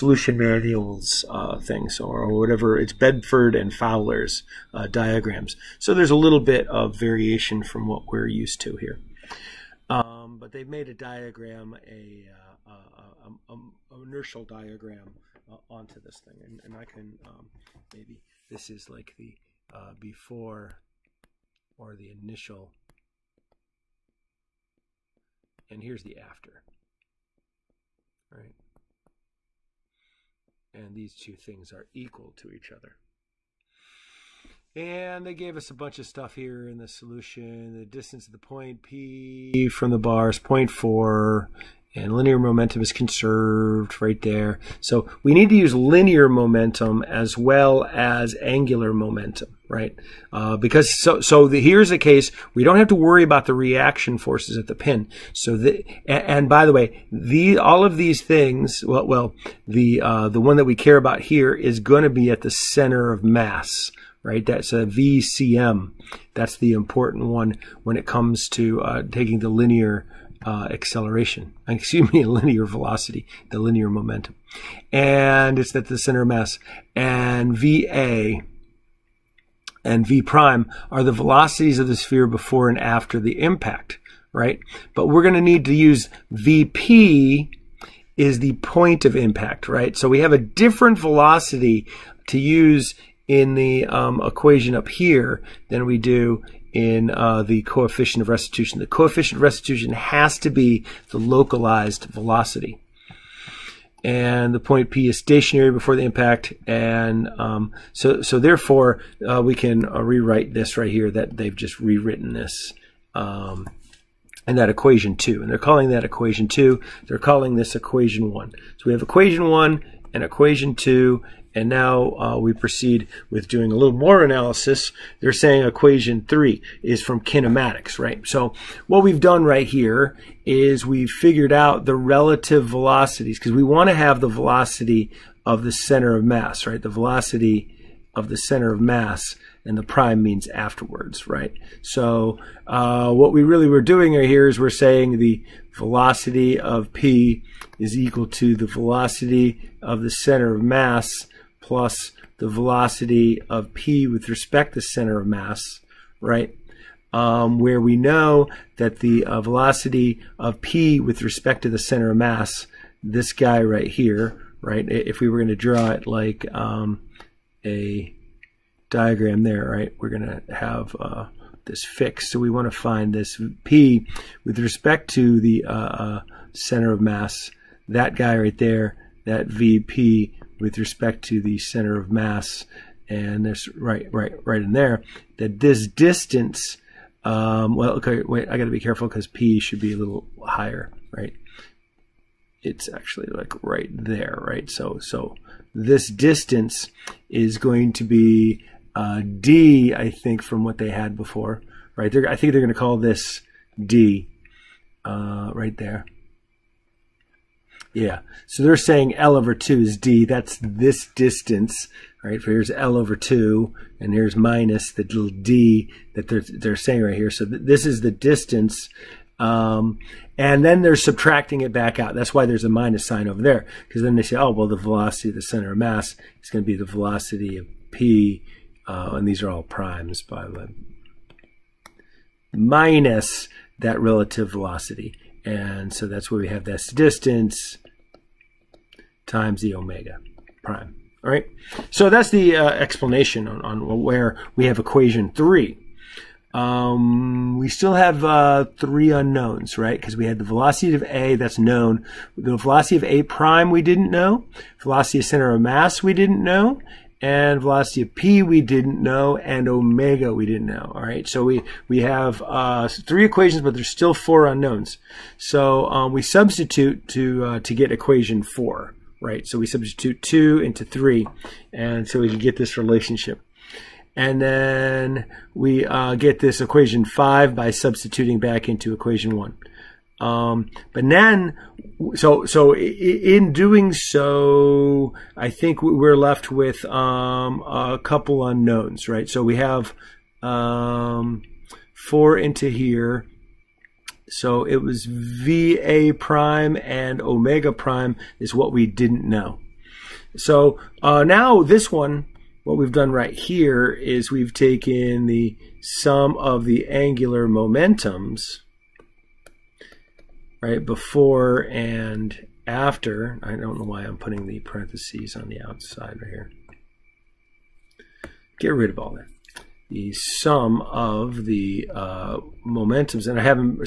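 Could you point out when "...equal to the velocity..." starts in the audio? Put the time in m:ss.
2:27.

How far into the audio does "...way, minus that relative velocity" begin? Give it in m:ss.
3:50.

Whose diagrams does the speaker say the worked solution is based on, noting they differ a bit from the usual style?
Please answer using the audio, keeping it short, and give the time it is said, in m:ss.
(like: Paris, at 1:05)
Bedford and Fowler, at 0:02.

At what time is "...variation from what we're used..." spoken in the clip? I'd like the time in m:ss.
0:06.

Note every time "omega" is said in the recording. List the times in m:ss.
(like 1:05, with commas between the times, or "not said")
3:59, 4:19, 4:57.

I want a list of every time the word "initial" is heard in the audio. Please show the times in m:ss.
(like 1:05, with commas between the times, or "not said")
0:22.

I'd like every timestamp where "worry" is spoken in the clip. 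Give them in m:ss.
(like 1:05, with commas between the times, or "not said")
0:52.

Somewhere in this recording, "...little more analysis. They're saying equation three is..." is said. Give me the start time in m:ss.
2:03.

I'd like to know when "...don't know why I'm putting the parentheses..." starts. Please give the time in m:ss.
5:13.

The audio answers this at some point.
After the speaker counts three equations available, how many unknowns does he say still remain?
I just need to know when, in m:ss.
4:24.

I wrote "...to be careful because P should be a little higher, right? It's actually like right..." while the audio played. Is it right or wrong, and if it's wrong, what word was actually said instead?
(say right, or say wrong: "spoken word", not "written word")
right.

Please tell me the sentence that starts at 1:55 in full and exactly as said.
And they're calling that equation 2.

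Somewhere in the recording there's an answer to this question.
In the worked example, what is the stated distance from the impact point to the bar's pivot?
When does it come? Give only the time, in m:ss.
0:40.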